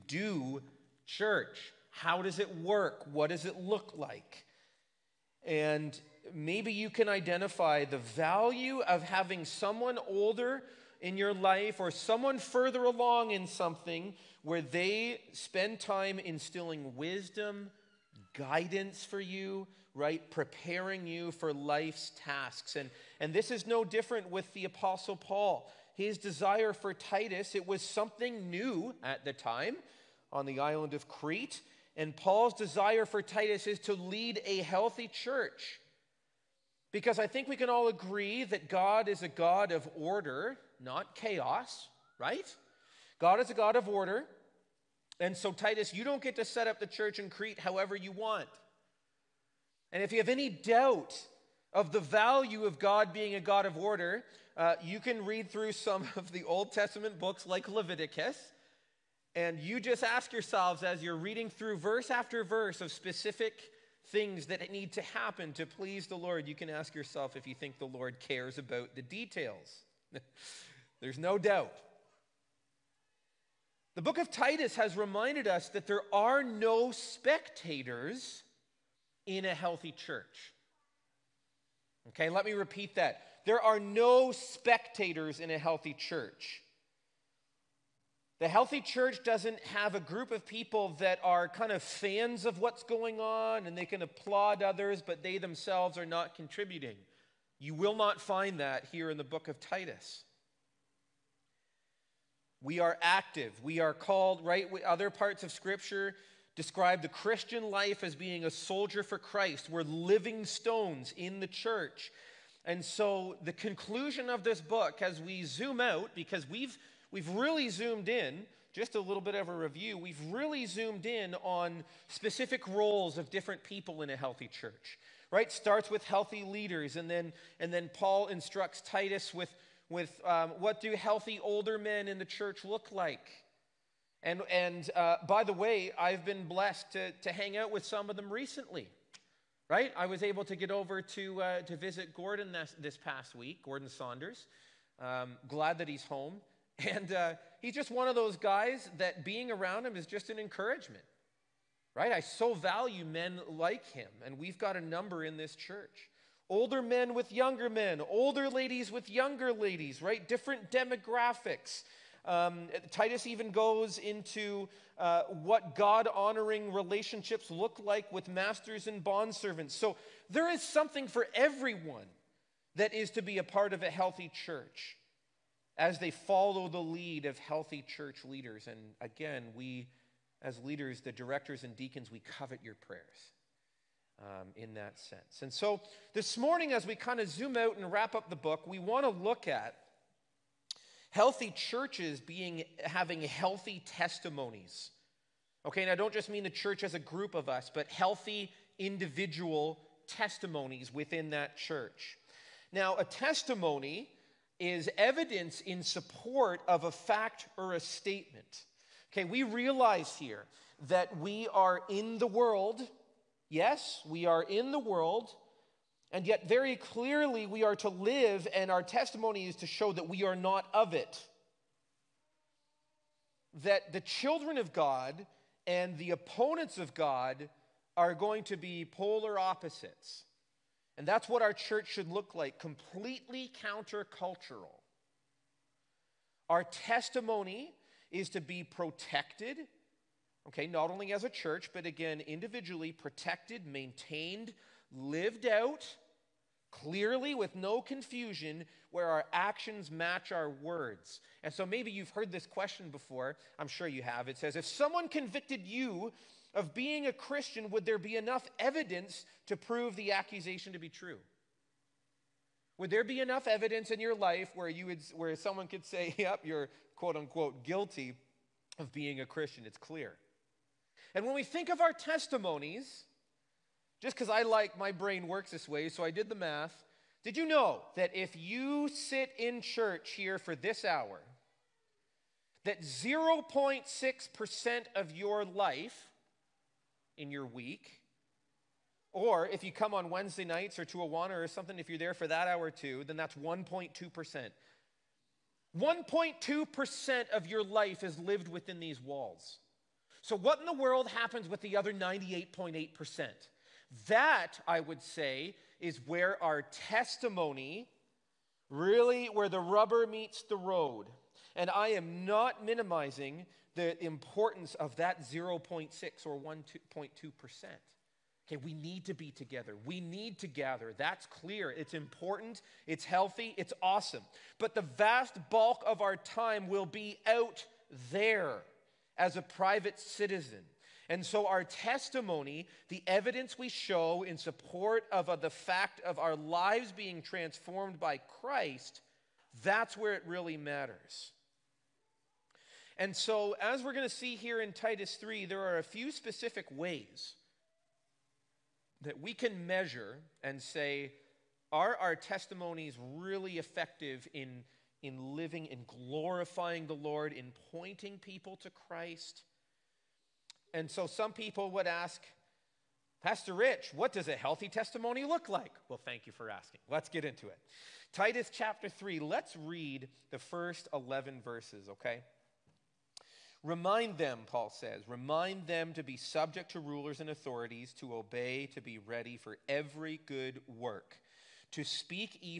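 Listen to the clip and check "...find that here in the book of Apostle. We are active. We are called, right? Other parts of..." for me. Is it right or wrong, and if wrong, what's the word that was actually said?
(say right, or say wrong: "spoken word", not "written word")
wrong: "Titus", not "Apostle".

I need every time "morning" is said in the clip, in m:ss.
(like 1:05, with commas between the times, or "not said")
3:06.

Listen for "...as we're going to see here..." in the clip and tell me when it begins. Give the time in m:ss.
5:43.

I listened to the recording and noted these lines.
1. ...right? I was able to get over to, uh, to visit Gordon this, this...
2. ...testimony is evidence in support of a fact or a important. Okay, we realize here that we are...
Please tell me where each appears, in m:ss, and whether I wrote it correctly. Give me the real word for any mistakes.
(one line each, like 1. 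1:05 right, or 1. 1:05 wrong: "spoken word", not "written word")
1. 2:19 right
2. 3:23 wrong: "statement", not "important".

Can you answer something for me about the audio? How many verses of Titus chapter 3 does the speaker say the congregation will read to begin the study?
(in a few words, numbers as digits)
11.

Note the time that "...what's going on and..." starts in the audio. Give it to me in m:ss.
1:32.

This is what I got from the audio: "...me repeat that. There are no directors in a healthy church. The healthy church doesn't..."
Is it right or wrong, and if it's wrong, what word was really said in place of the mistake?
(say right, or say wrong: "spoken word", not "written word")
wrong: "spectators", not "directors".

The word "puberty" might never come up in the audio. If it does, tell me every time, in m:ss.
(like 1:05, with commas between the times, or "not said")
not said.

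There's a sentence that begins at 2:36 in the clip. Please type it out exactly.
Older men with younger men, older ladies with younger ladies, right?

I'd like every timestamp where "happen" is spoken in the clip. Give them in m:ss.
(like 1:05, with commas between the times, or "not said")
1:05, 5:01.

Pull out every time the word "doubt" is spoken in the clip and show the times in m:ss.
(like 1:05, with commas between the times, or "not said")
0:50, 1:11.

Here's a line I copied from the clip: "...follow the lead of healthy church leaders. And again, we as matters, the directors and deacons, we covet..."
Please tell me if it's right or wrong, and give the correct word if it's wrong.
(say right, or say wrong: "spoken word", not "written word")
wrong: "leaders", not "matters".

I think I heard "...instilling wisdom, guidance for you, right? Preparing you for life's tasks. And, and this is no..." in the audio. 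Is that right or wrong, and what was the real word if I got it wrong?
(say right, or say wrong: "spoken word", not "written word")
right.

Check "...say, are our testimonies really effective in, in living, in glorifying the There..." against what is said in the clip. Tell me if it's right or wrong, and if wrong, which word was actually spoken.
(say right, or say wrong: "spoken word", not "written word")
wrong: "Lord", not "There".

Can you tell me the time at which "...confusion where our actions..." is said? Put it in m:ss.
4:07.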